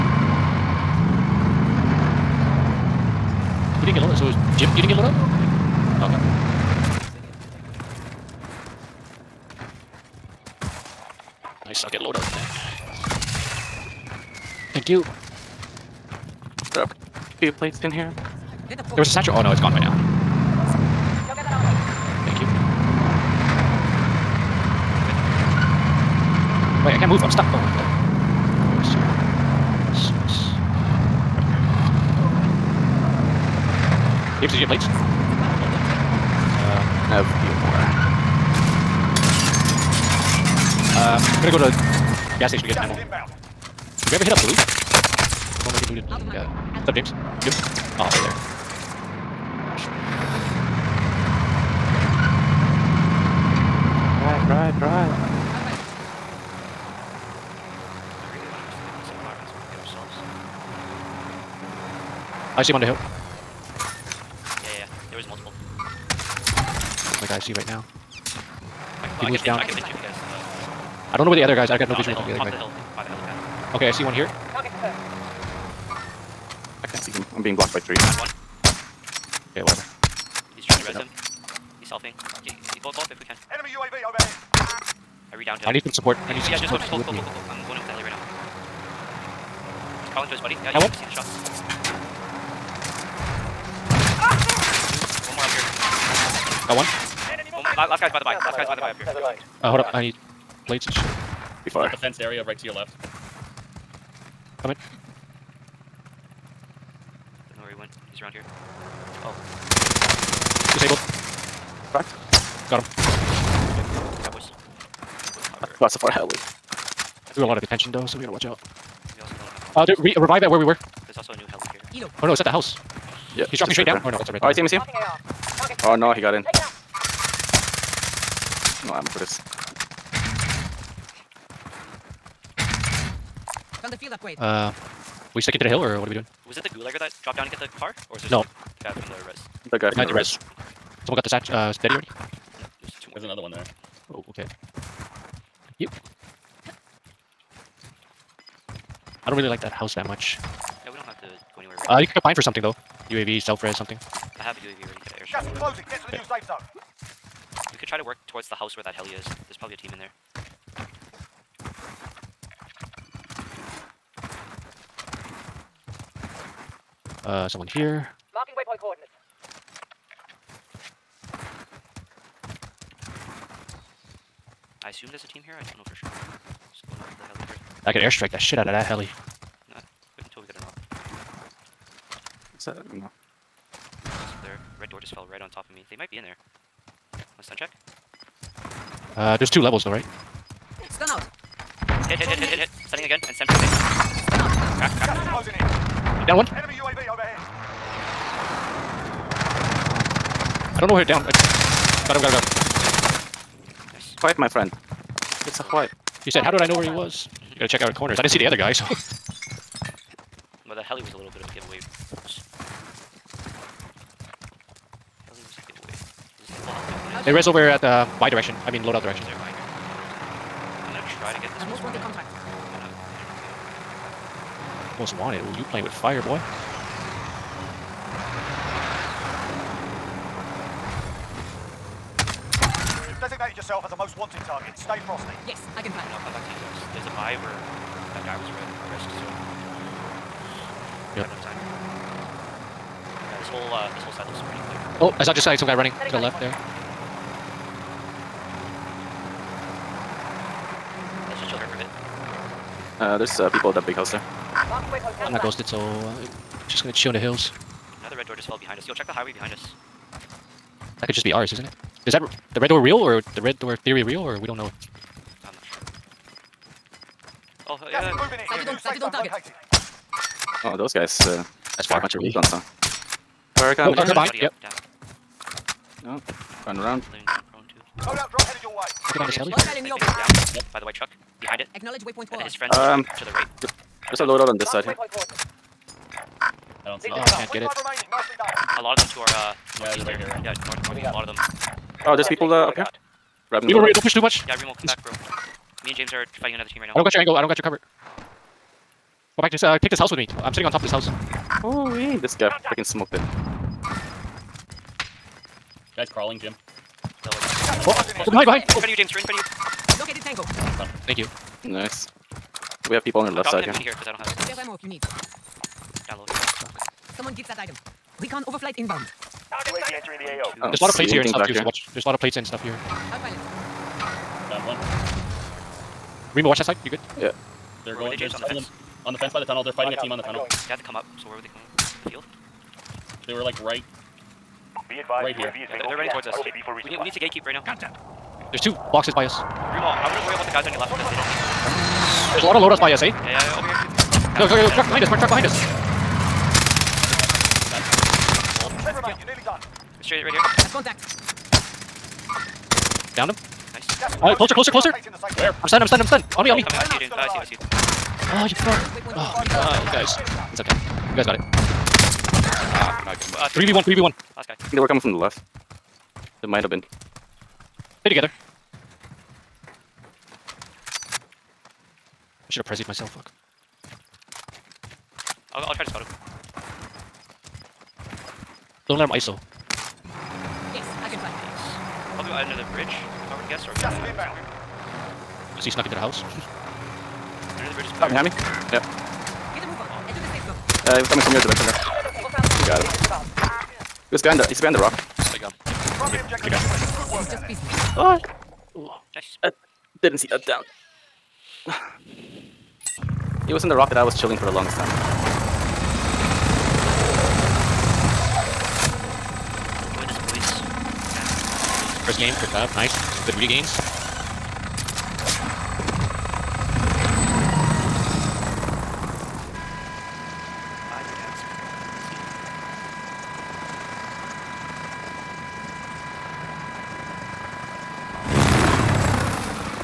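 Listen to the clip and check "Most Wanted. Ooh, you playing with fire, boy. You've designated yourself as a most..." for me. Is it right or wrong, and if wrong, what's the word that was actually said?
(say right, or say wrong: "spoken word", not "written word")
right.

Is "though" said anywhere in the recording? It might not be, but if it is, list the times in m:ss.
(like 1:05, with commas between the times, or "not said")
1:57, 2:32, 3:09, 6:31.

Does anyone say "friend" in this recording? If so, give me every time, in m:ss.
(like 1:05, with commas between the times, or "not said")
3:24, 4:42.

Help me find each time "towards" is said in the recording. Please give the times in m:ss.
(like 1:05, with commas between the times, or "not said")
2:38, 5:36.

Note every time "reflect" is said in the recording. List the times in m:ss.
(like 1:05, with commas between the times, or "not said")
not said.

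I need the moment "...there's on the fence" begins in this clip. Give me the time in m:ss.
5:28.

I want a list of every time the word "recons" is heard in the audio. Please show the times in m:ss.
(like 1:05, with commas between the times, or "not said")
4:32, 5:18.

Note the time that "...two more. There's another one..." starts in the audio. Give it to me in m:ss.
2:23.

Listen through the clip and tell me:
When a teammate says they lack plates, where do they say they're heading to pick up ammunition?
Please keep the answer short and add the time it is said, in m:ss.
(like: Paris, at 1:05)
gas station, at 0:42.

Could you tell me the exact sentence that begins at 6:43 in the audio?
It was in the rock that I was chilling for the longest time.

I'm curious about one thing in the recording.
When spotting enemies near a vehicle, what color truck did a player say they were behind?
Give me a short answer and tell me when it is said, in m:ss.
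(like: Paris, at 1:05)
white, at 4:40.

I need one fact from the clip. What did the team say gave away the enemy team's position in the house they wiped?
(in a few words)
the heli.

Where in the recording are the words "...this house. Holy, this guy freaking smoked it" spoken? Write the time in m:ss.
5:00.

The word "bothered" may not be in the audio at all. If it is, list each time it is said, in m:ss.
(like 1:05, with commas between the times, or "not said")
not said.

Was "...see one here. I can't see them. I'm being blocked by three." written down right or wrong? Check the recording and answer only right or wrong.
right.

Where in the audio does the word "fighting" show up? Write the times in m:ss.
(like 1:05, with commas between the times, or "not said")
4:56, 5:29.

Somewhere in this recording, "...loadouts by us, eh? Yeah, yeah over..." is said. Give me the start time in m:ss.
5:42.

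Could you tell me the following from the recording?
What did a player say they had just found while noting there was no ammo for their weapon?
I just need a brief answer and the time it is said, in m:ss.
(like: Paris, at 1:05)
field upgrade, at 2:13.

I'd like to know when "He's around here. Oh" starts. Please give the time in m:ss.
1:48.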